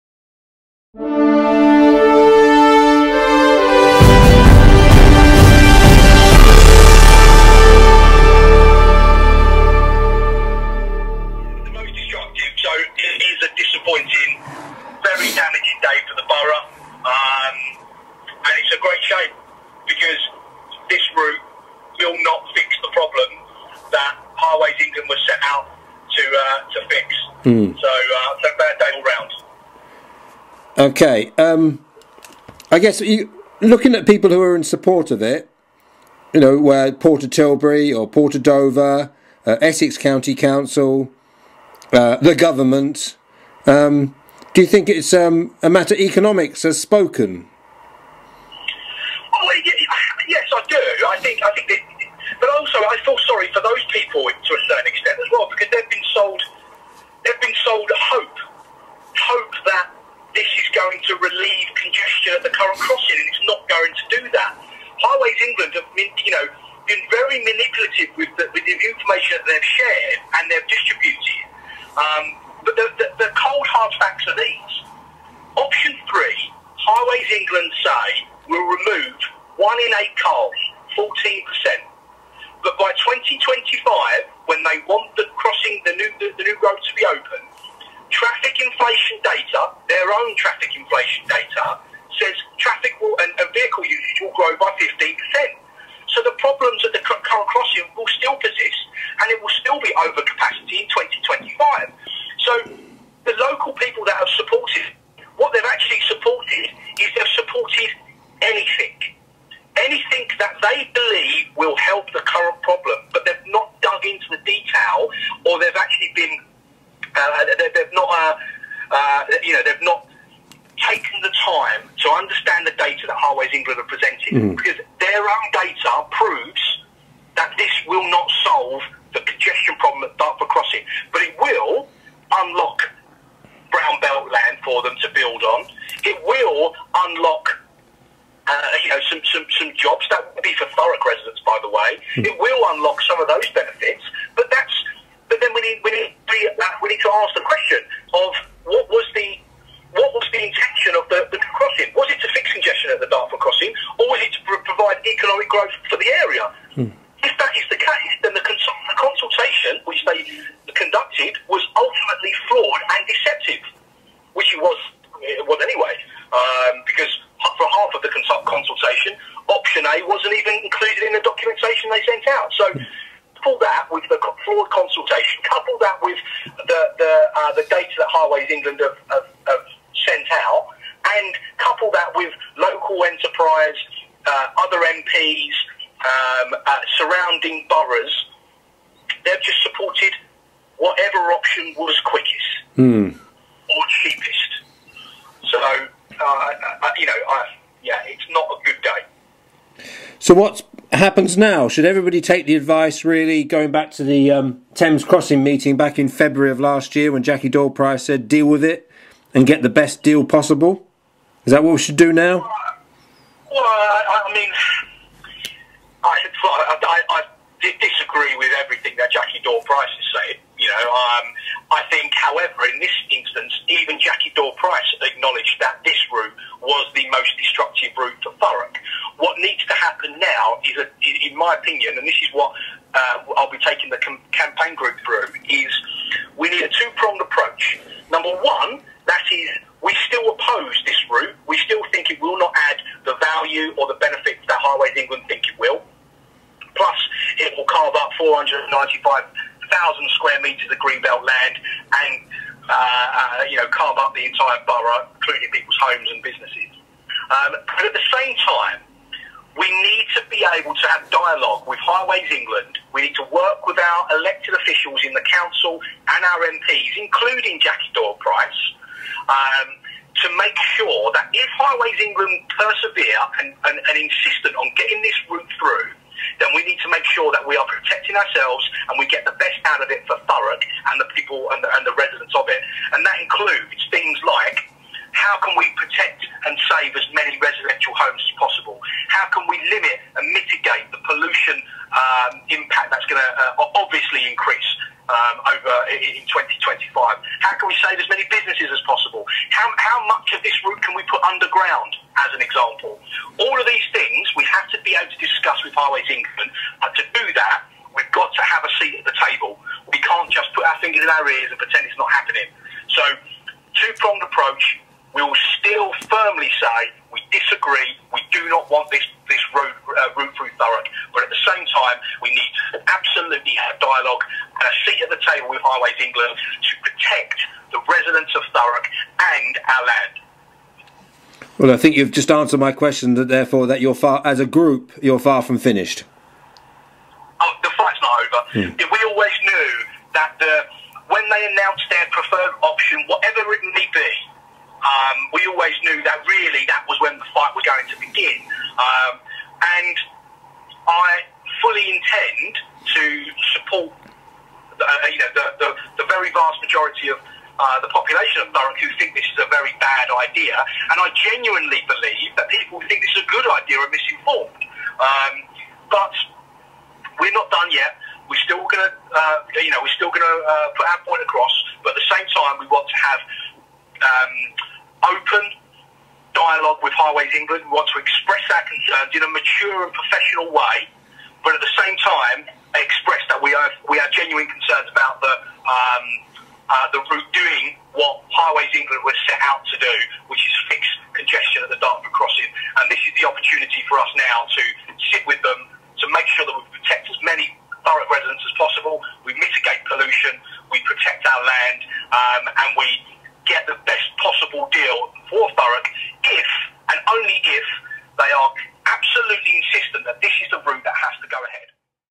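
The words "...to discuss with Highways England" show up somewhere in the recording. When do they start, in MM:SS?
05:05.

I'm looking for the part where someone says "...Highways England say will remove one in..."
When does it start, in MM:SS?
01:16.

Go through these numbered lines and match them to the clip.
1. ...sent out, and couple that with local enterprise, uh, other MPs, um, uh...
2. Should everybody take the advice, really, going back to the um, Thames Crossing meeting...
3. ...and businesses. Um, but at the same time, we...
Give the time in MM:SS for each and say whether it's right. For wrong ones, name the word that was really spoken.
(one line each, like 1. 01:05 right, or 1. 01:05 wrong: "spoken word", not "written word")
1. 03:00 right
2. 03:21 right
3. 04:16 right.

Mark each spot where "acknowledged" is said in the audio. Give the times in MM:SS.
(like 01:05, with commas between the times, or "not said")
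03:45.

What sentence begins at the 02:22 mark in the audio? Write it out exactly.
It will unlock some of those benefits, but that's.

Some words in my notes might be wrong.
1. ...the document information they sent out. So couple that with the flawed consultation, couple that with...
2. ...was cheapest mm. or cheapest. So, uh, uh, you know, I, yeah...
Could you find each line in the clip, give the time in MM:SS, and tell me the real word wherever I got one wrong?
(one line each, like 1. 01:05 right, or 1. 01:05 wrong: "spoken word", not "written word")
1. 02:51 right
2. 03:11 wrong: "quickest", not "cheapest".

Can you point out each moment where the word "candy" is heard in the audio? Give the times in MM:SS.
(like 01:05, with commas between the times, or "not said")
not said.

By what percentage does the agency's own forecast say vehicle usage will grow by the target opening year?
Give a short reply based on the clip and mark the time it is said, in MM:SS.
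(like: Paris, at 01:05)
15%, at 01:34.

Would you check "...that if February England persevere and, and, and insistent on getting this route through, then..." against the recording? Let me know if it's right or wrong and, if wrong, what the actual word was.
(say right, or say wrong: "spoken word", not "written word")
wrong: "Highways", not "February".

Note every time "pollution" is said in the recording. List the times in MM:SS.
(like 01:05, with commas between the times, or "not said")
04:51, 06:39.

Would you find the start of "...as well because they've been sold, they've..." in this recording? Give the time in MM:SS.
00:55.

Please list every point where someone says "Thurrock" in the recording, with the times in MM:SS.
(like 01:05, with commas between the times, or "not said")
04:40, 05:20, 05:28, 05:58.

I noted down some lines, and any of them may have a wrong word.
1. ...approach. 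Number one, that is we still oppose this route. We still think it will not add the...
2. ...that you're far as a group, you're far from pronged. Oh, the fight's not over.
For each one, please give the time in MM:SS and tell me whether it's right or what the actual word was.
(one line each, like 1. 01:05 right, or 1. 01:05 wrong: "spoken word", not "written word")
1. 03:57 right
2. 05:33 wrong: "finished", not "pronged".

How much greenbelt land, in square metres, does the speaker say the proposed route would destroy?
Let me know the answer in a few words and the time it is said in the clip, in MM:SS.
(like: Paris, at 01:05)
495,000 square metres, at 04:08.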